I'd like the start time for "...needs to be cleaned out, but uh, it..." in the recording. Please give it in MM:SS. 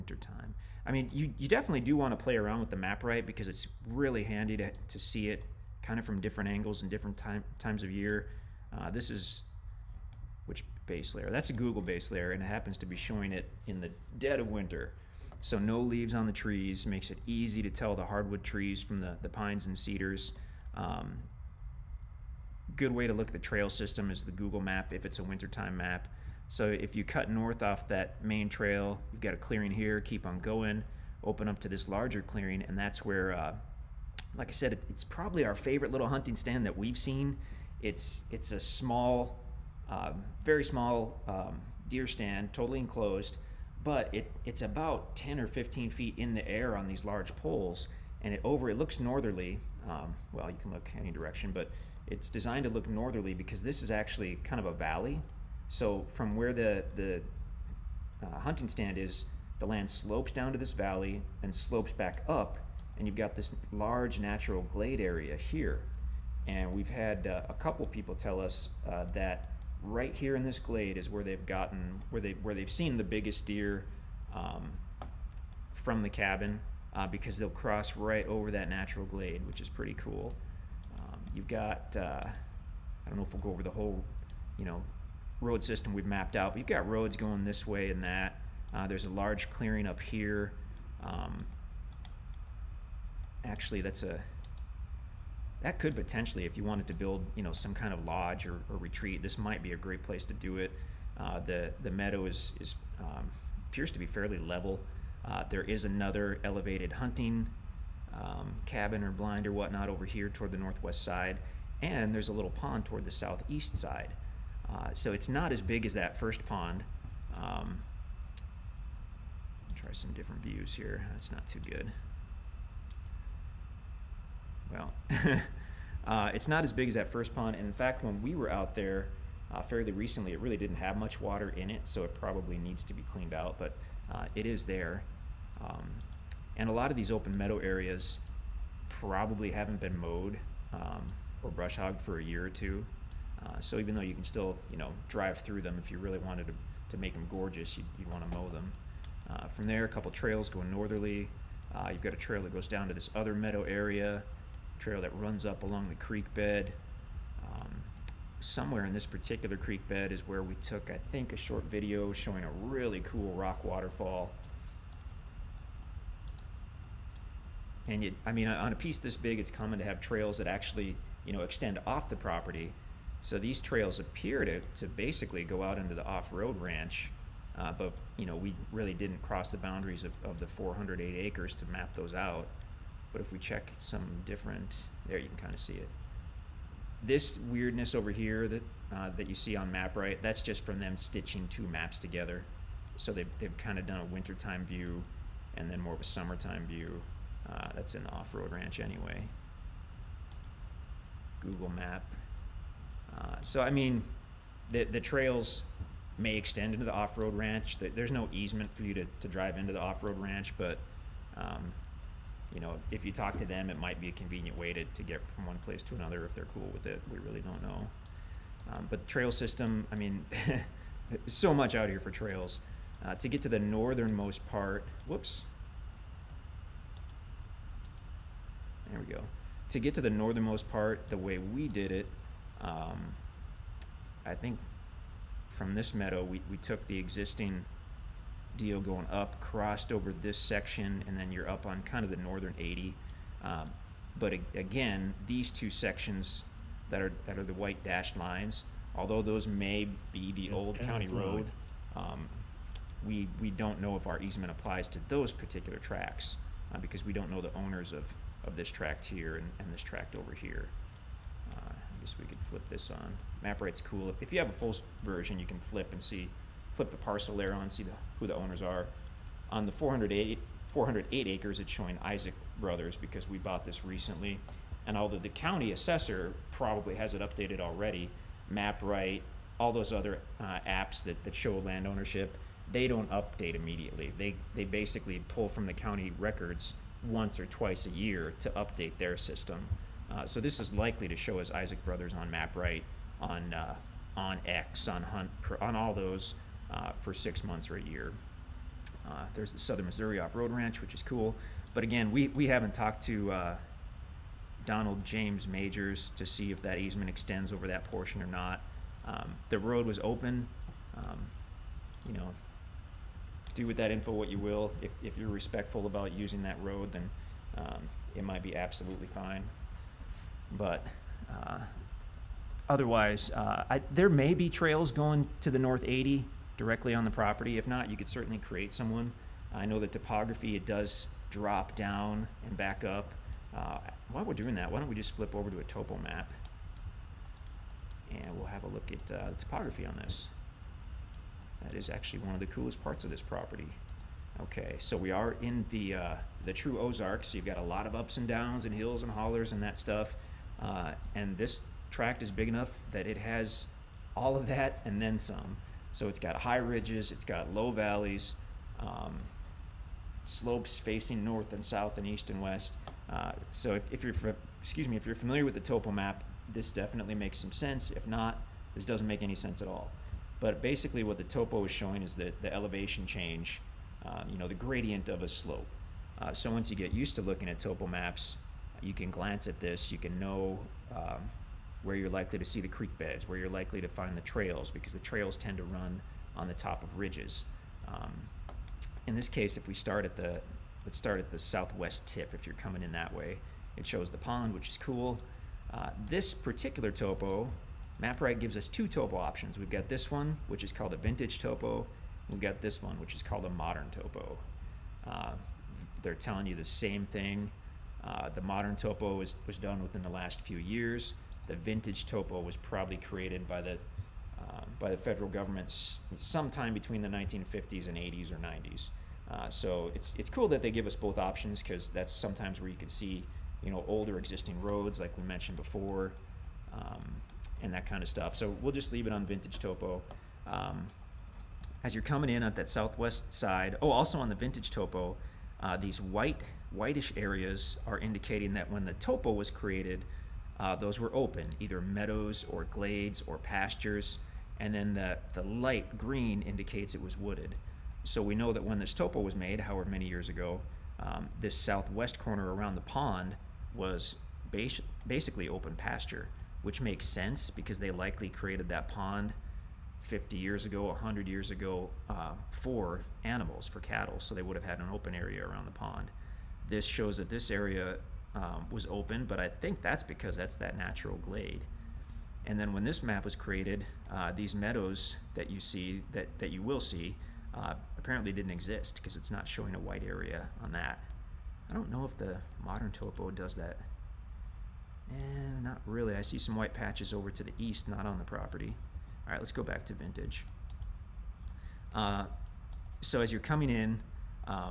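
02:12.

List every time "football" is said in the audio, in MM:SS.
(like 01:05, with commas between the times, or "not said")
not said.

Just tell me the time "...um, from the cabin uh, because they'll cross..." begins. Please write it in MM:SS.
01:14.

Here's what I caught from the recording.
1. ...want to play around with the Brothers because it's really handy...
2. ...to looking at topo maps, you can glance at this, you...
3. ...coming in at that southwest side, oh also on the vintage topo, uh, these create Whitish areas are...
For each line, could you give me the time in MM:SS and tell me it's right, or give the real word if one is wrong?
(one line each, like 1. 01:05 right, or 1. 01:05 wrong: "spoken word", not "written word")
1. 00:01 wrong: "MapRight", not "Brothers"
2. 06:17 right
3. 07:12 wrong: "white", not "create".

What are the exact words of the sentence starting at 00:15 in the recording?
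So no leaves on the trees makes it easy to tell the hardwood trees from the, the pines and cedars.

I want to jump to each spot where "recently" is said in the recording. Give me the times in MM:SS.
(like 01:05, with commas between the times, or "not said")
02:09, 04:33.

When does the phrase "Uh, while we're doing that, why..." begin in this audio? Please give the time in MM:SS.
05:33.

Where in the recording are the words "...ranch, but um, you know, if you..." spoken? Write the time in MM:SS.
03:30.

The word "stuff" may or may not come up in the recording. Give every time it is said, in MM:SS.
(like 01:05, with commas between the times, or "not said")
05:49, 07:08.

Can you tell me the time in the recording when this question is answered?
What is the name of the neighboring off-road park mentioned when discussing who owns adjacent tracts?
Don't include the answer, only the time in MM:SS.
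04:59.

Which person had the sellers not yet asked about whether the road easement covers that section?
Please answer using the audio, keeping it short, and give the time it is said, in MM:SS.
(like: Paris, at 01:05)
Donald James Majors, at 05:04.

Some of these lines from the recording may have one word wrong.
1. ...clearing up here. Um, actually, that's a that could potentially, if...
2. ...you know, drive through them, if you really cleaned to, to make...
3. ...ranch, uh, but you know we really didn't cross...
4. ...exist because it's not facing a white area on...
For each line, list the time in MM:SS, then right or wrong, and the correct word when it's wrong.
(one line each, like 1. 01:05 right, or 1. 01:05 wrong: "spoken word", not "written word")
1. 01:29 right
2. 02:24 wrong: "wanted", not "cleaned"
3. 02:56 right
4. 07:58 wrong: "showing", not "facing".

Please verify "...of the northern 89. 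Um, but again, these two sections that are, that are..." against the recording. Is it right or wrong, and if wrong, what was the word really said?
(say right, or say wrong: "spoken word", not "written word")
wrong: "80", not "89".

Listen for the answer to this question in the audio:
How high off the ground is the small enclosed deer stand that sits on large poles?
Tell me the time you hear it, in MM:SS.
00:45.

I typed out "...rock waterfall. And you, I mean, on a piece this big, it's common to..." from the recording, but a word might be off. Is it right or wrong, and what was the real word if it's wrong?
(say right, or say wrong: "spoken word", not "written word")
right.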